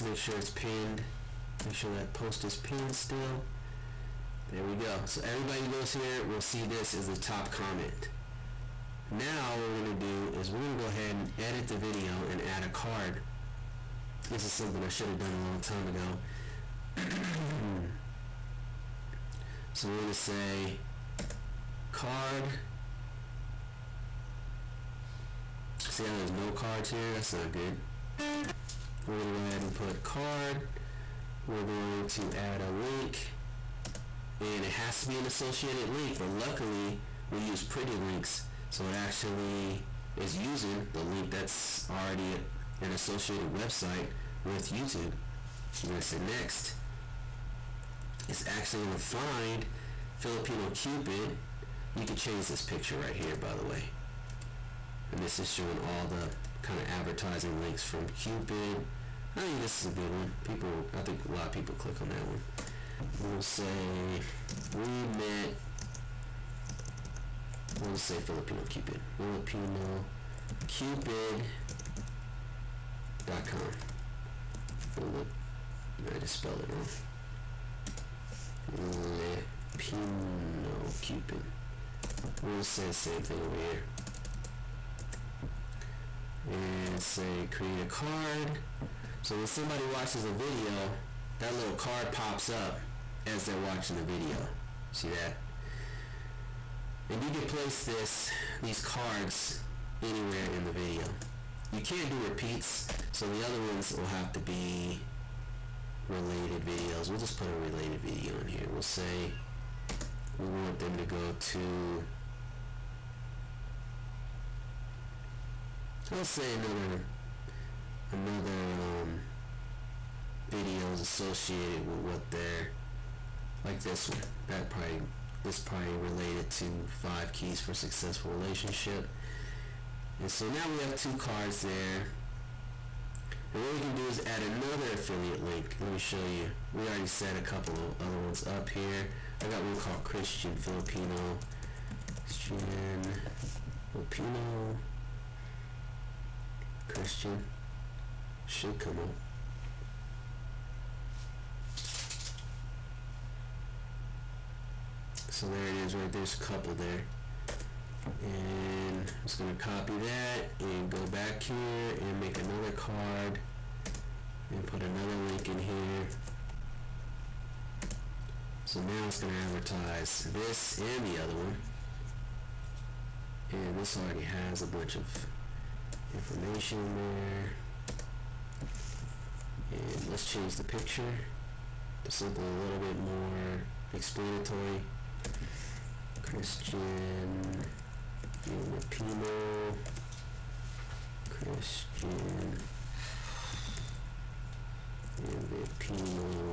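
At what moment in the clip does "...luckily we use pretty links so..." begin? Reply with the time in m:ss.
0:36.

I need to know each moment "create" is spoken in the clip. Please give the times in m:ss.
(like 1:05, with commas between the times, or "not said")
1:27.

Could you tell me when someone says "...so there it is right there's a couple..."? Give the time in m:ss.
2:35.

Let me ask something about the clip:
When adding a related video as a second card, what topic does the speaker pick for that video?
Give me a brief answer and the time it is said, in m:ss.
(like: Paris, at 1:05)
Five keys for successful relationship, at 2:07.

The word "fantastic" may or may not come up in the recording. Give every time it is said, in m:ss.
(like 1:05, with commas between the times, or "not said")
not said.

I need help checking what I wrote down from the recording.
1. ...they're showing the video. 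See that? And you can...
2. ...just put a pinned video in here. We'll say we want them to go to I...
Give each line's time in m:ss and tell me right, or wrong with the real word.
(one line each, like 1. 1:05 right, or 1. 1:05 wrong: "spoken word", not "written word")
1. 1:33 wrong: "watching", not "showing"
2. 1:47 wrong: "related", not "pinned".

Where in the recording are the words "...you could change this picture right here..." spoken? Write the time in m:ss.
0:51.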